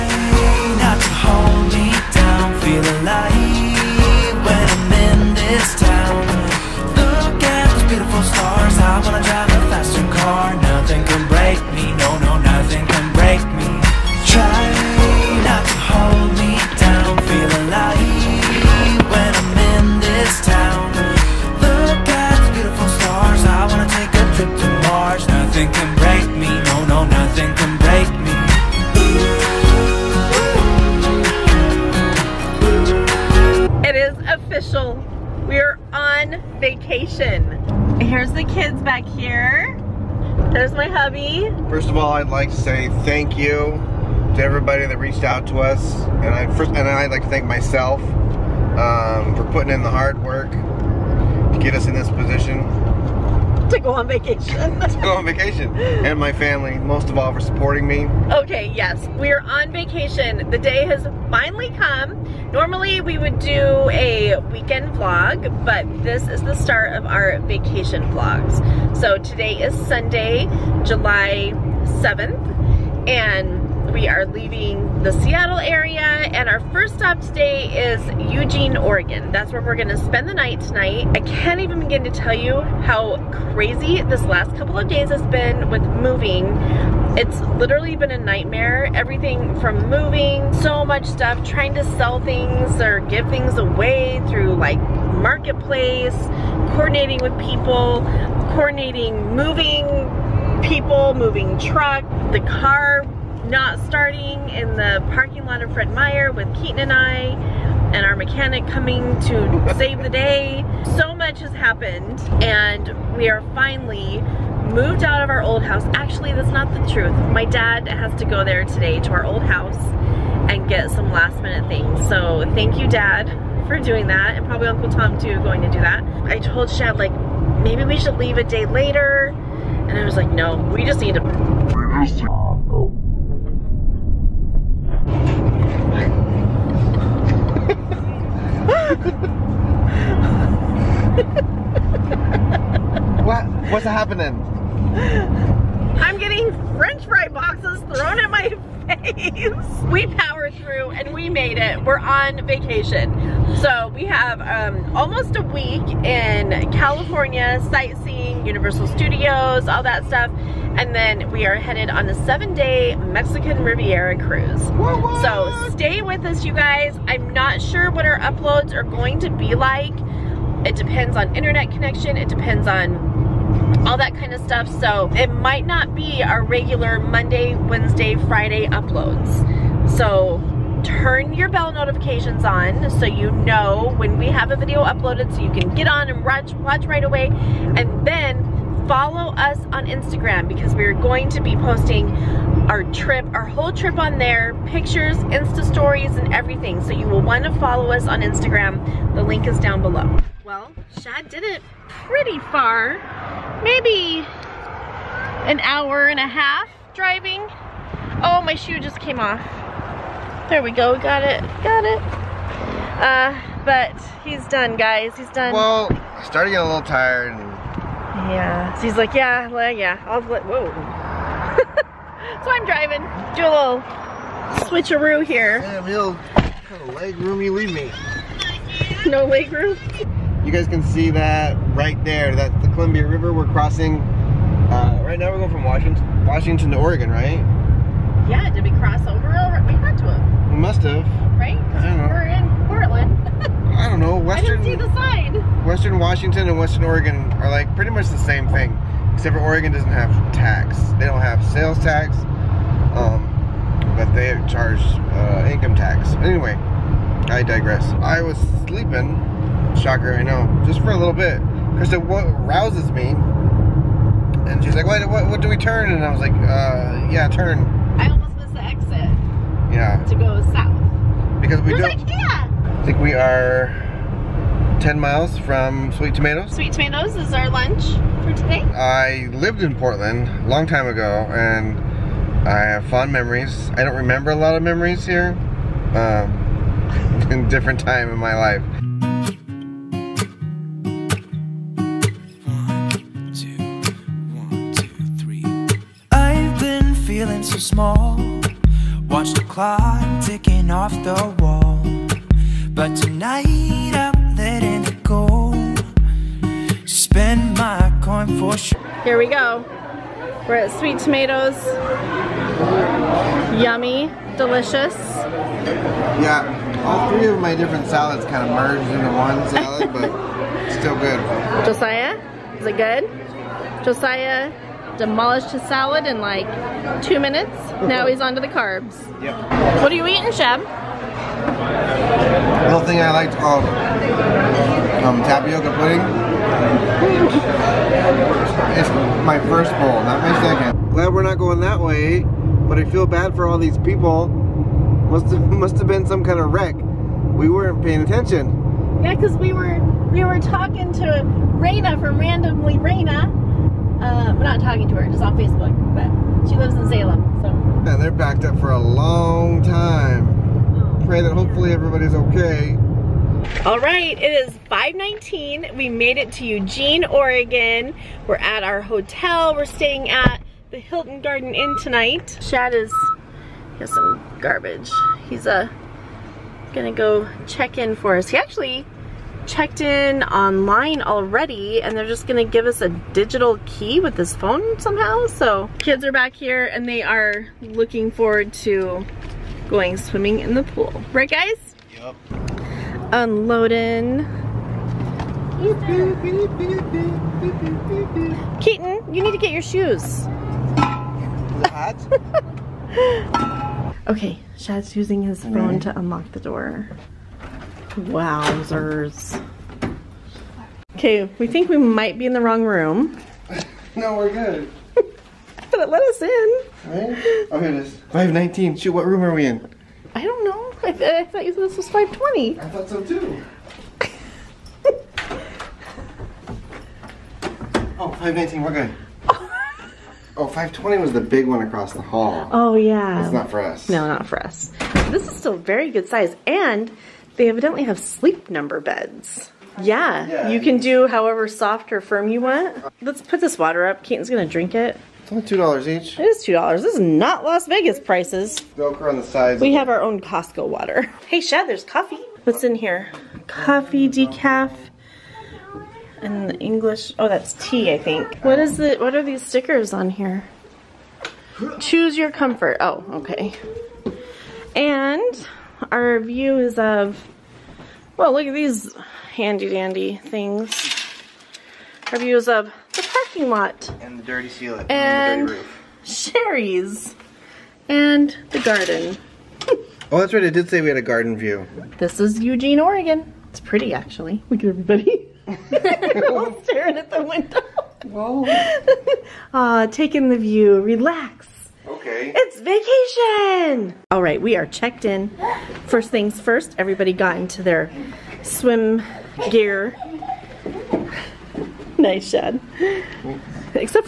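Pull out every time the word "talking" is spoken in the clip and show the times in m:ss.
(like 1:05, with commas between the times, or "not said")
5:50, 5:54.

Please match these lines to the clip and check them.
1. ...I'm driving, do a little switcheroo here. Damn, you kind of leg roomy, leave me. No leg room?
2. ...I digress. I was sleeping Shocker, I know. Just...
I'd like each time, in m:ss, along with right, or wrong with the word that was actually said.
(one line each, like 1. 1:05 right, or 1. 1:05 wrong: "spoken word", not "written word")
1. 3:42 right
2. 4:17 right.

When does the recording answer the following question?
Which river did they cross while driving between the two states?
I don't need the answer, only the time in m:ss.
3:52.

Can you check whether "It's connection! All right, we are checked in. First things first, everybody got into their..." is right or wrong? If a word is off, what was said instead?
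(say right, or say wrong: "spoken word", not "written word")
wrong: "vacation", not "connection".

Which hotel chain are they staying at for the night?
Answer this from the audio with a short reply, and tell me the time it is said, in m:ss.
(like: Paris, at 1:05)
Hilton Garden Inn, at 6:10.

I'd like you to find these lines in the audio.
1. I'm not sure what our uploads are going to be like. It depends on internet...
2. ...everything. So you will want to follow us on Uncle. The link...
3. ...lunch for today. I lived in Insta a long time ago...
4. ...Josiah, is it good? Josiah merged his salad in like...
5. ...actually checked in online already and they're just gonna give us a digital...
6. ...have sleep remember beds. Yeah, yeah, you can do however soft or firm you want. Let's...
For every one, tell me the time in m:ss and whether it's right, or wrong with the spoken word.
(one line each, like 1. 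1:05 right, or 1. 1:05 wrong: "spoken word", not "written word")
1. 2:47 right
2. 3:16 wrong: "Instagram", not "Uncle"
3. 4:37 wrong: "Portland", not "Insta"
4. 5:21 wrong: "demolished", not "merged"
5. 6:18 right
6. 7:17 wrong: "number", not "remember".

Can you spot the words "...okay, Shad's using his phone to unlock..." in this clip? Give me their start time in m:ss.
6:44.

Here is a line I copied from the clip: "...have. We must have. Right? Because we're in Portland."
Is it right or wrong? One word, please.
right.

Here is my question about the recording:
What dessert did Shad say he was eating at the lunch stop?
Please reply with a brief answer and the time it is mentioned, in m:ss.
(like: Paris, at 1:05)
tapioca pudding, at 5:35.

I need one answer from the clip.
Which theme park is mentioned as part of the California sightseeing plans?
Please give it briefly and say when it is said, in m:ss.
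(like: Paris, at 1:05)
Universal Studios, at 2:38.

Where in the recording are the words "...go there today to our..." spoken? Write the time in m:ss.
1:58.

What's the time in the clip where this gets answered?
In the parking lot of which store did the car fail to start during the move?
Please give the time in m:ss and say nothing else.
1:45.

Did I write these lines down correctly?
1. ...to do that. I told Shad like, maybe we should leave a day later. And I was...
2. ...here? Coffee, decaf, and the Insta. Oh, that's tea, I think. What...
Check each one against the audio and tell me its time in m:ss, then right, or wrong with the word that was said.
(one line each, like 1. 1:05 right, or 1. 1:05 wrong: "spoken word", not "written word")
1. 2:05 right
2. 7:32 wrong: "English", not "Insta".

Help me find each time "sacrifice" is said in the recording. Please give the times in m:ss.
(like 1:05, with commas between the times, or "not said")
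not said.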